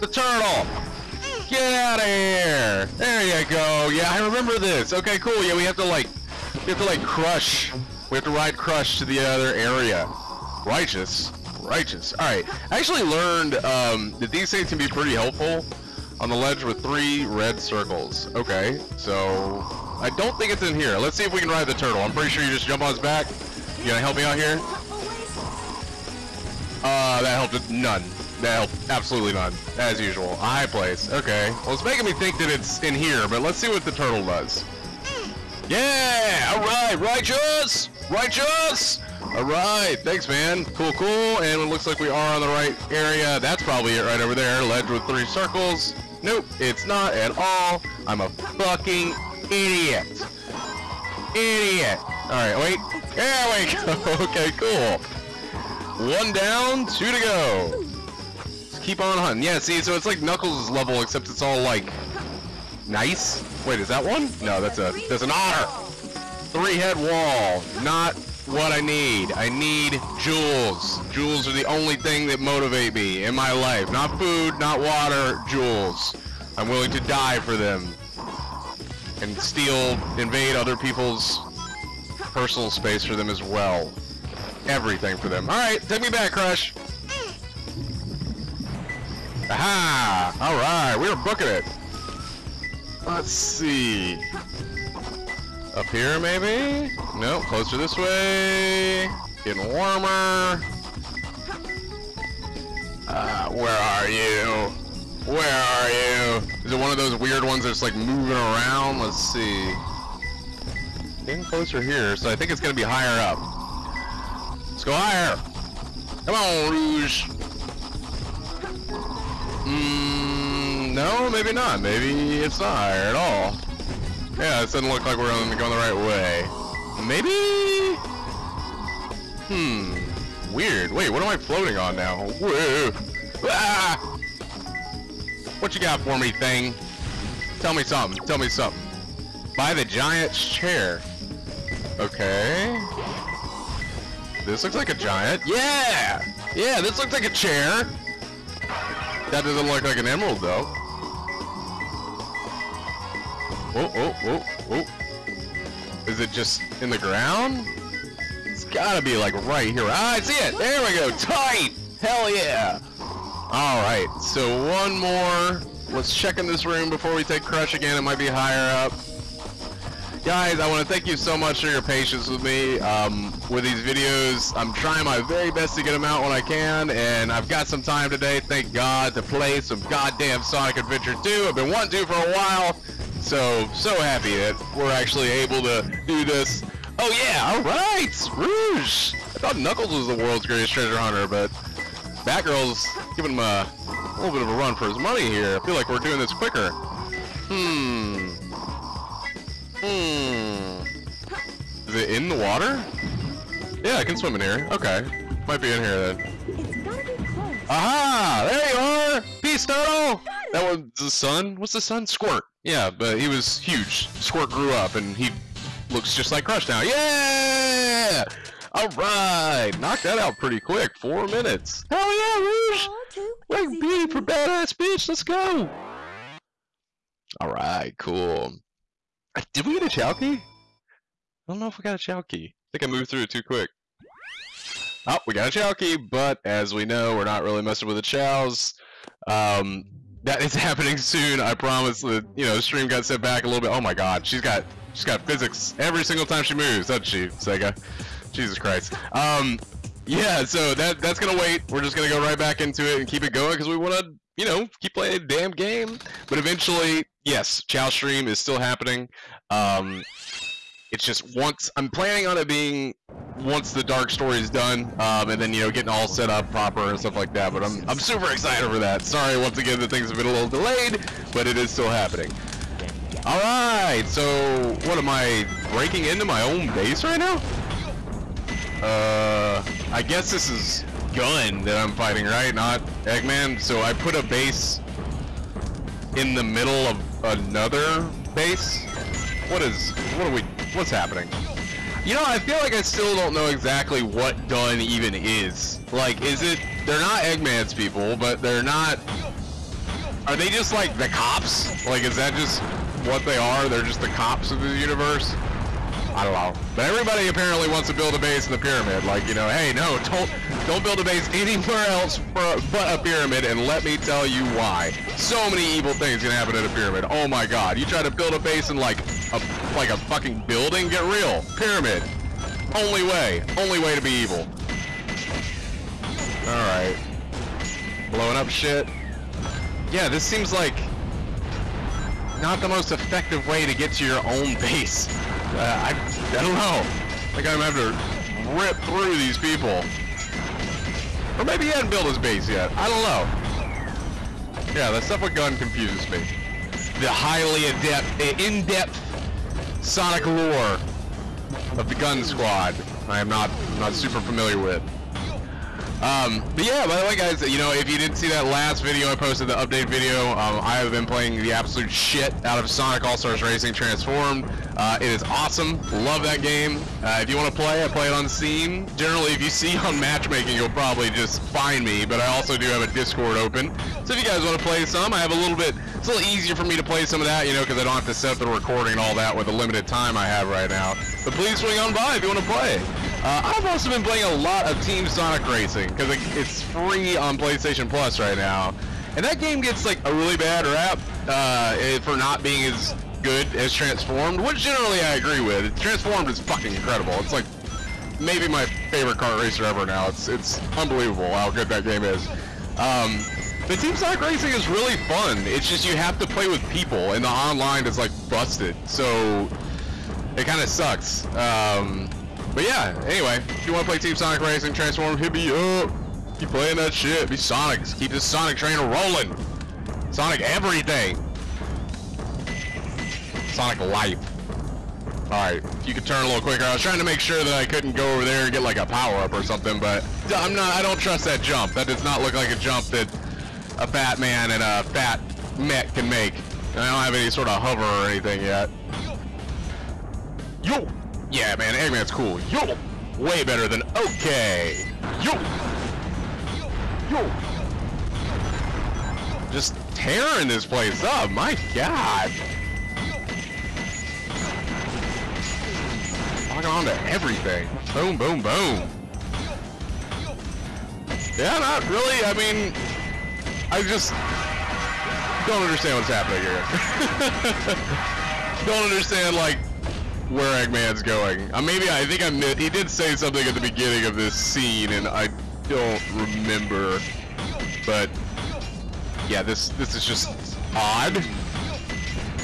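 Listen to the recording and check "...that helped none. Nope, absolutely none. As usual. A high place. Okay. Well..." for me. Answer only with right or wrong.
right.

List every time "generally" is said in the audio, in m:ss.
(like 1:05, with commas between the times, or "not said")
6:08, 6:34.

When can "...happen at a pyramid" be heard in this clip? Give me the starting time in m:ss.
5:16.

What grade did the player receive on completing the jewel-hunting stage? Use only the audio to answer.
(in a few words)
B.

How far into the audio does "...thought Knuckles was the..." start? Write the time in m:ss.
3:09.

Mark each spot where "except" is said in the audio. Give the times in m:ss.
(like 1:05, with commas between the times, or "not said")
1:01.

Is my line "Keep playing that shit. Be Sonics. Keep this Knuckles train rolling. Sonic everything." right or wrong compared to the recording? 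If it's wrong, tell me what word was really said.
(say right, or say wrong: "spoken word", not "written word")
wrong: "Sonic", not "Knuckles".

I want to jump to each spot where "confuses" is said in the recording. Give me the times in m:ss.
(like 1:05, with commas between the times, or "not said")
5:45.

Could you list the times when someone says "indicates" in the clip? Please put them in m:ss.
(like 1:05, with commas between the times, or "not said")
not said.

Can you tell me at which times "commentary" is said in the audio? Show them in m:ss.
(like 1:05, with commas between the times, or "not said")
not said.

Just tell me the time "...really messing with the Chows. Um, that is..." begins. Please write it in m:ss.
3:57.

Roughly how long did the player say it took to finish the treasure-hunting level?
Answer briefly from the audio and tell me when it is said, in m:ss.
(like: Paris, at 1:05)
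4 minutes, at 3:40.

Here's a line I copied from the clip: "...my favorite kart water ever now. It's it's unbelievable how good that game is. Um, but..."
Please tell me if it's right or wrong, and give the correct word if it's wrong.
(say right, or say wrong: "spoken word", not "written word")
wrong: "racer", not "water".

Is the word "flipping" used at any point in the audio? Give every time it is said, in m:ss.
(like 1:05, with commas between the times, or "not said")
not said.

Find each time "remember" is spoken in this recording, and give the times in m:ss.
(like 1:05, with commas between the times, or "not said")
0:04, 7:56.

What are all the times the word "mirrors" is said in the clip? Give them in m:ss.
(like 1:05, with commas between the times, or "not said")
not said.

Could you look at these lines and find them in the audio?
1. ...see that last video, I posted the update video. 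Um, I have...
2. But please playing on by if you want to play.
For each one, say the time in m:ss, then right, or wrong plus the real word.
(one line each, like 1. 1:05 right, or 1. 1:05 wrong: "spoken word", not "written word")
1. 5:58 right
2. 6:21 wrong: "swing", not "playing".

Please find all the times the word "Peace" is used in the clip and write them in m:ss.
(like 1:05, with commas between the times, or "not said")
3:29.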